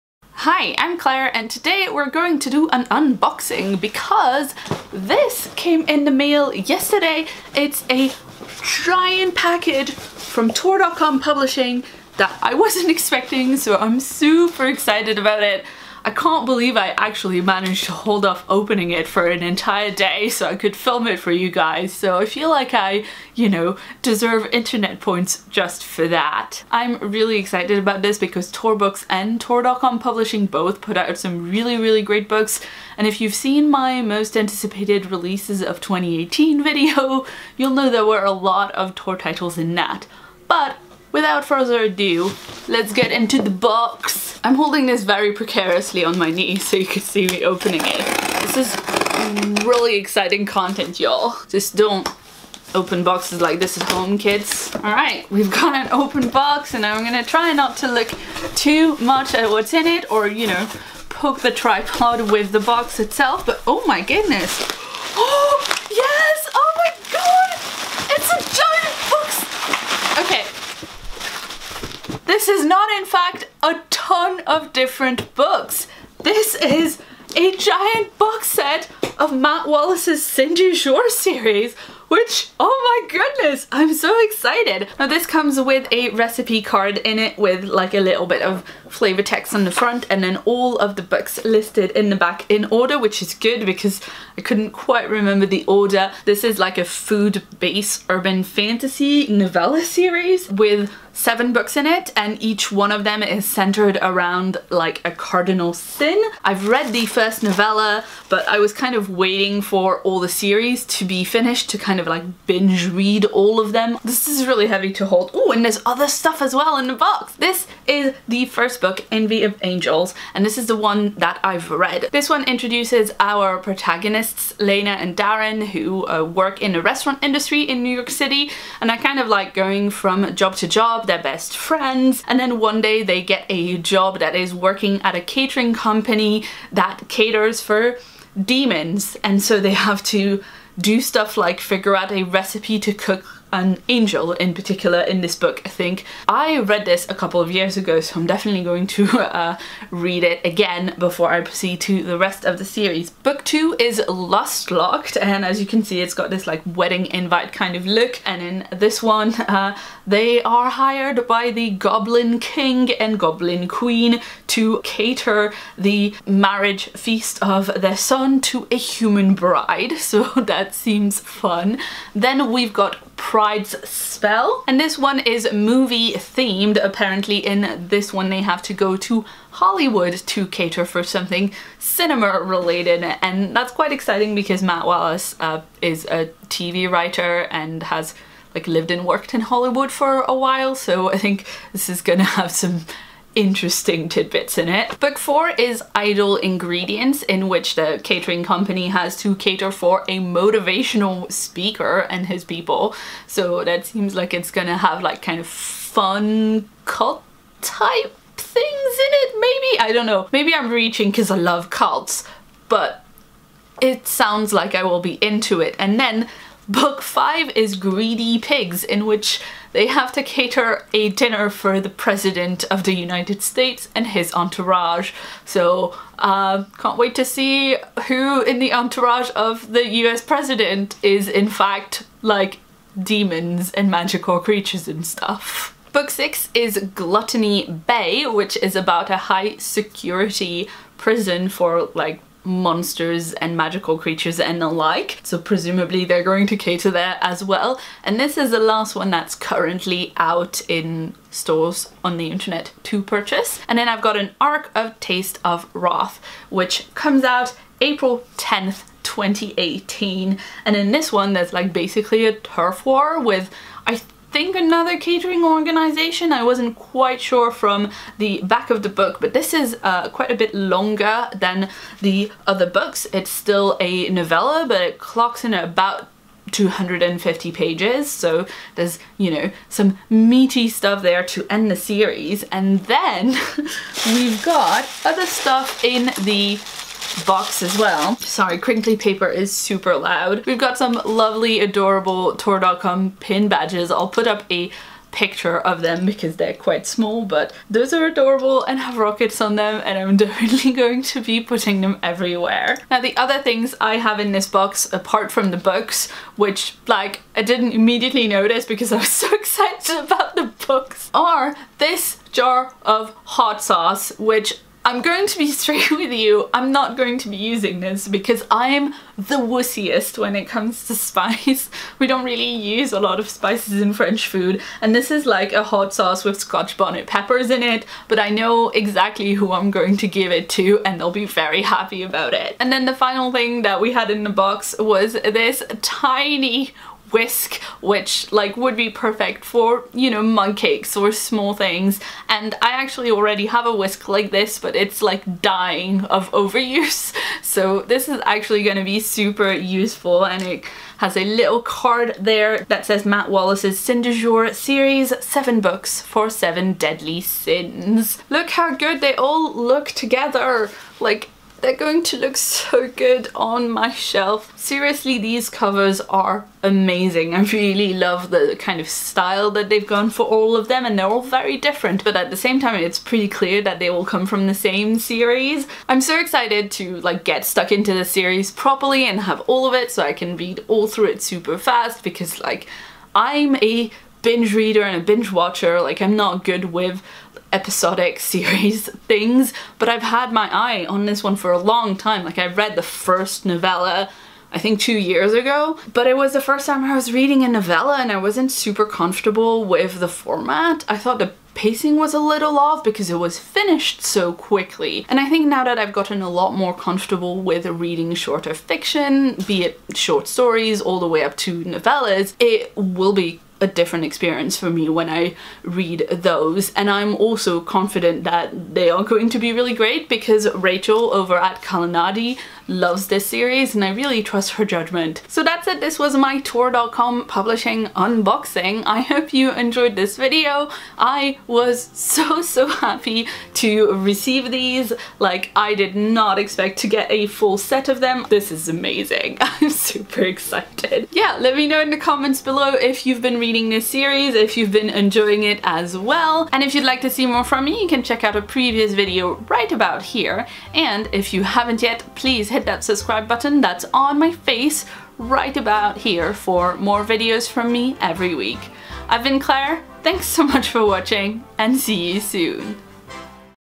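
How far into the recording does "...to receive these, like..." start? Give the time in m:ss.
7:13.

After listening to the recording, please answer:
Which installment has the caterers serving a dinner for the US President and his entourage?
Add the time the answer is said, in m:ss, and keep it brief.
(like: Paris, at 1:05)
Greedy Pigs, at 3:37.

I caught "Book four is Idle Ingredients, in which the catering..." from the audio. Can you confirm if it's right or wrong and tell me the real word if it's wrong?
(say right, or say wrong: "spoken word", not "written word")
right.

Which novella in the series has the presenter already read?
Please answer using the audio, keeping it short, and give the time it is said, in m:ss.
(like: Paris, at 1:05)
Envy of Angels, at 1:59.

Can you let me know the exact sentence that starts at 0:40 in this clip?
But without further ado, let's get into the box.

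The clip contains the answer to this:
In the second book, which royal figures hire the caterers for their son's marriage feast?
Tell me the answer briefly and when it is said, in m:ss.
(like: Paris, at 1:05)
Goblin King and Goblin Queen, at 2:41.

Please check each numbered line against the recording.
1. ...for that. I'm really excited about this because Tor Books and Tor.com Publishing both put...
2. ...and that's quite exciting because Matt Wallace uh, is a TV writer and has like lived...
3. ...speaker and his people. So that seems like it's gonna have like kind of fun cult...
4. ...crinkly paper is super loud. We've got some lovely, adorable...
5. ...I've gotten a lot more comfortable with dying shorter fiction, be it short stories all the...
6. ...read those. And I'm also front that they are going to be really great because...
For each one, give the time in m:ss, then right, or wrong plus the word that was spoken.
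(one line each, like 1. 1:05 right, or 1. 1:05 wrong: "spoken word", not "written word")
1. 0:25 right
2. 3:03 right
3. 3:21 right
4. 4:48 right
5. 6:45 wrong: "reading", not "dying"
6. 6:55 wrong: "confident", not "front".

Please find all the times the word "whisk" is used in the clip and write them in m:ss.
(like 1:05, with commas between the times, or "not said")
5:37, 5:43.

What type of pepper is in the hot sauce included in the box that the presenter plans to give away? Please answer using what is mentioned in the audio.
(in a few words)
scotch bonnet.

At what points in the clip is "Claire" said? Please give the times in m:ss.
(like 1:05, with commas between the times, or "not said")
0:00, 7:39.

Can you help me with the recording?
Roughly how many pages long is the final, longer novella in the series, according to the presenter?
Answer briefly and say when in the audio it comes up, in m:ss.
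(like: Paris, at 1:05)
250, at 4:36.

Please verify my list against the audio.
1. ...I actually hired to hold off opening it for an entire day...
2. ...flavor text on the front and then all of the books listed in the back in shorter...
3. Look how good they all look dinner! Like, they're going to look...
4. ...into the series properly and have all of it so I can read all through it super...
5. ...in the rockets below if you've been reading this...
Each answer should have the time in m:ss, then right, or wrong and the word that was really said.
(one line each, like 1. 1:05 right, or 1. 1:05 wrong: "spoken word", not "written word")
1. 0:16 wrong: "managed", not "hired"
2. 1:28 wrong: "order", not "shorter"
3. 5:58 wrong: "together", not "dinner"
4. 6:17 right
5. 7:21 wrong: "comments", not "rockets".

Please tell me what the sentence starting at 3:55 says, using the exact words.
Book 6 is Gluttony Bay, which is about a high security prison for like monsters and magical creatures and the like.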